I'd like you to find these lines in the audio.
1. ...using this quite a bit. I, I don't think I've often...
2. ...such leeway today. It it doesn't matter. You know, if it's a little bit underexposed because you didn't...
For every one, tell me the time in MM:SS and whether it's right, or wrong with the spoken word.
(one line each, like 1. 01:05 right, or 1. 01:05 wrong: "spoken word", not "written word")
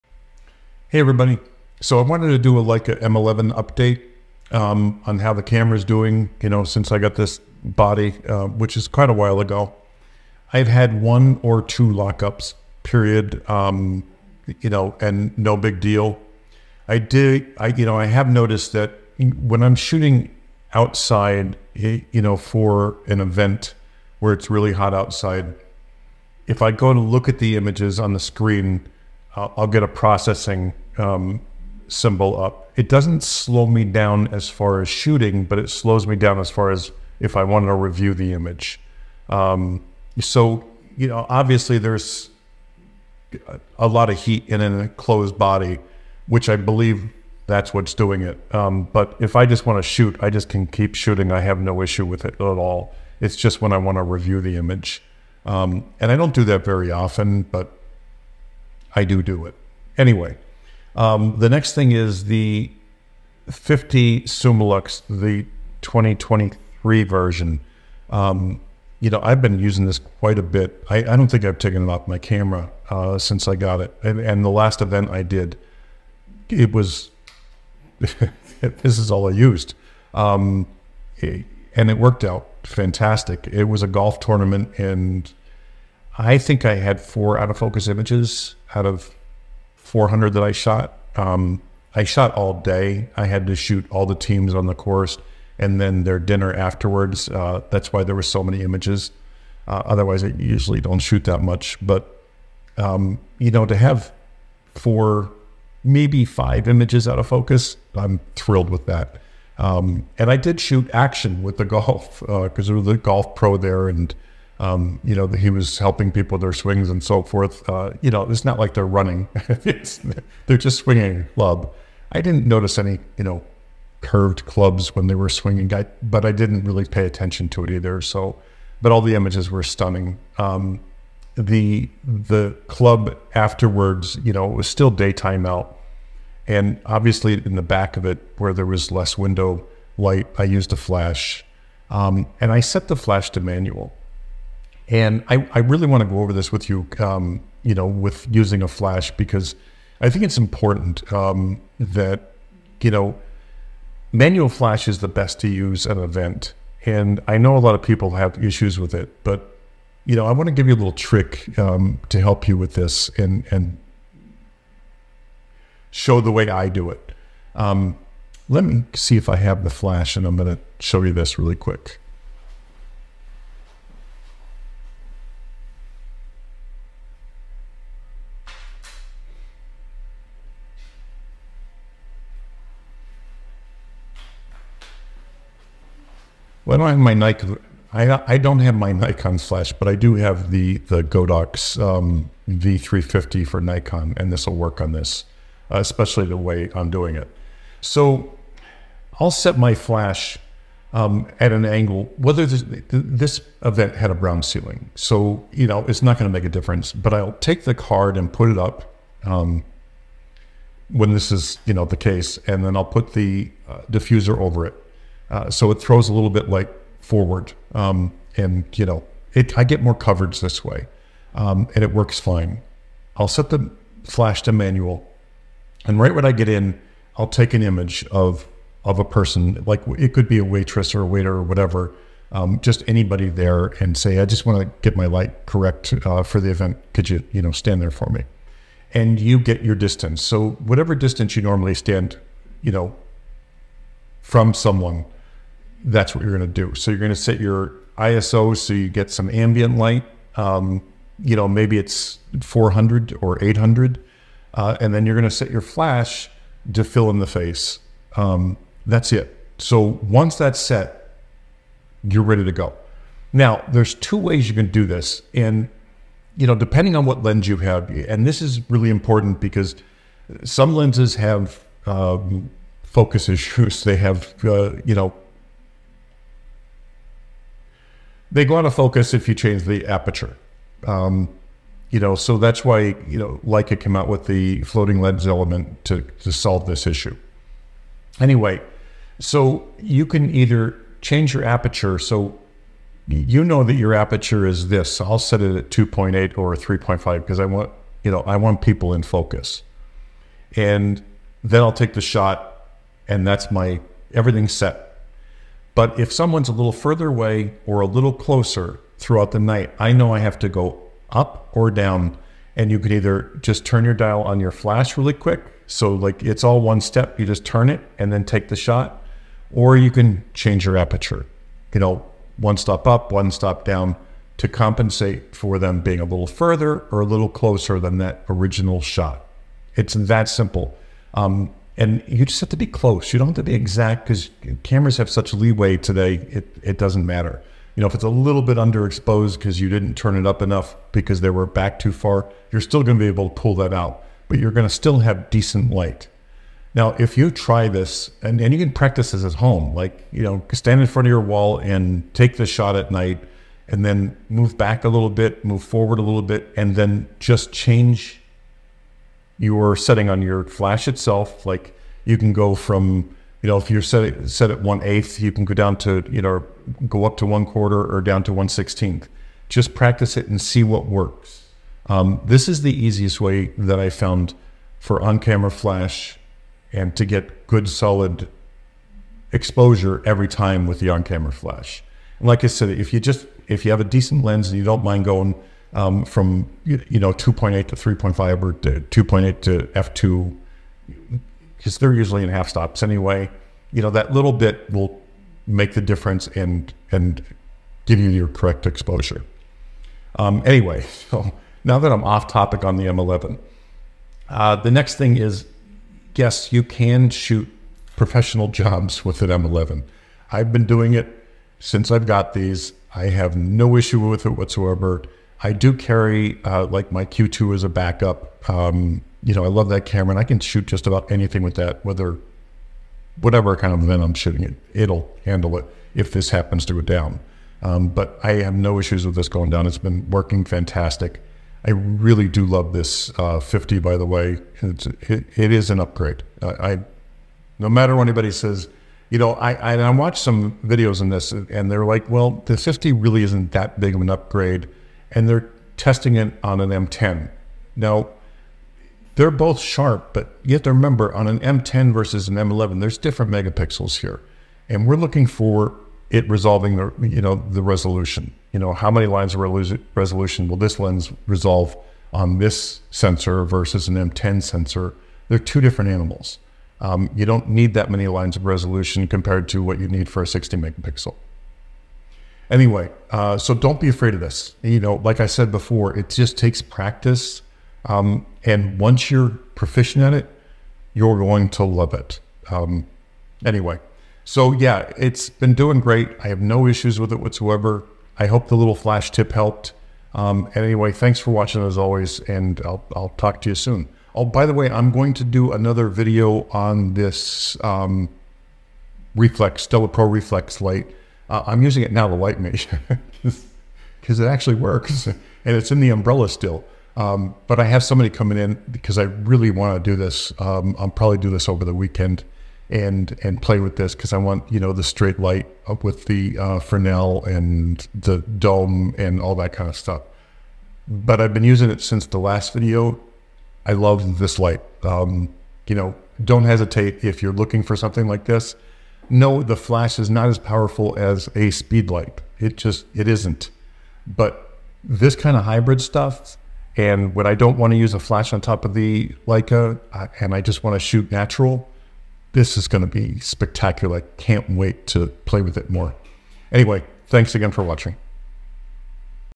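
1. 01:09 wrong: "taken", not "often"
2. 05:35 right.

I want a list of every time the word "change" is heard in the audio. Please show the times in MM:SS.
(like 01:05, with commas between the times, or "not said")
04:39, 04:51, 05:20, 05:57.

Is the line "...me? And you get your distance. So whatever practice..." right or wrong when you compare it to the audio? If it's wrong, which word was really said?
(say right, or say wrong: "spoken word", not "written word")
wrong: "distance", not "practice".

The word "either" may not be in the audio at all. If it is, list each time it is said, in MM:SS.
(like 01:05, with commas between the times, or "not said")
02:07, 04:50, 05:12.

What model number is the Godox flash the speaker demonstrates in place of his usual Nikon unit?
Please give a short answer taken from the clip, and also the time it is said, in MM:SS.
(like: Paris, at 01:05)
V350, at 03:12.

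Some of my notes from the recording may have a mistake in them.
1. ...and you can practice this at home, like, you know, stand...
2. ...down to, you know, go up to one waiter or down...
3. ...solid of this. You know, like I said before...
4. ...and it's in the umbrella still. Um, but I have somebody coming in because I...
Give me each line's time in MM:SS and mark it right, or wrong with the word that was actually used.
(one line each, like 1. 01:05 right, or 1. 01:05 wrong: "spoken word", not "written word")
1. 05:48 right
2. 06:05 wrong: "quarter", not "waiter"
3. 07:53 wrong: "afraid", not "solid"
4. 08:25 right.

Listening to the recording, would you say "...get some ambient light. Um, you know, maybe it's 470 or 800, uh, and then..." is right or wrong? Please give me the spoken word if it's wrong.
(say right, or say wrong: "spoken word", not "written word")
wrong: "400", not "470".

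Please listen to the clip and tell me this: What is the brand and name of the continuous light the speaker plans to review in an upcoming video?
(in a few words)
Stella Pro Reflex.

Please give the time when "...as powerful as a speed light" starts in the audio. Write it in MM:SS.
08:50.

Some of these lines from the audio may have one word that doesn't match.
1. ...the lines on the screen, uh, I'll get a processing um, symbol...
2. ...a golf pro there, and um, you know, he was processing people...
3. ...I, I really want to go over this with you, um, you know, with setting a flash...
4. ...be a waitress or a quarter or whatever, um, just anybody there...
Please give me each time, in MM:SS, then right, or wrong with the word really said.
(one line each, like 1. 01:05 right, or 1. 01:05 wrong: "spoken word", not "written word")
1. 00:27 wrong: "images", not "lines"
2. 01:52 wrong: "helping", not "processing"
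3. 02:25 wrong: "using", not "setting"
4. 03:50 wrong: "waiter", not "quarter".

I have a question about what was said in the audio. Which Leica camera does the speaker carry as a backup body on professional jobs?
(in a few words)
Q2.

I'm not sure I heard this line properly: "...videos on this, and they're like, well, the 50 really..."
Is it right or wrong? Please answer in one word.
right.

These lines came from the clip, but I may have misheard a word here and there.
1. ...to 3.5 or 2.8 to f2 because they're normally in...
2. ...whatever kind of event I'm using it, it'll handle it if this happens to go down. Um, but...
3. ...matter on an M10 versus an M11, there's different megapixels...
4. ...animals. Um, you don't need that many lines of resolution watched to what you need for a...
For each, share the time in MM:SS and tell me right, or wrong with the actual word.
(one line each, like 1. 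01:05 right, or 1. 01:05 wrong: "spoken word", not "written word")
1. 06:27 wrong: "usually", not "normally"
2. 07:03 wrong: "shooting", not "using"
3. 07:30 wrong: "remember", not "matter"
4. 07:45 wrong: "compared", not "watched".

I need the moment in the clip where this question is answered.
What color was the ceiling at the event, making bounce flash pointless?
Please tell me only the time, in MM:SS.
03:24.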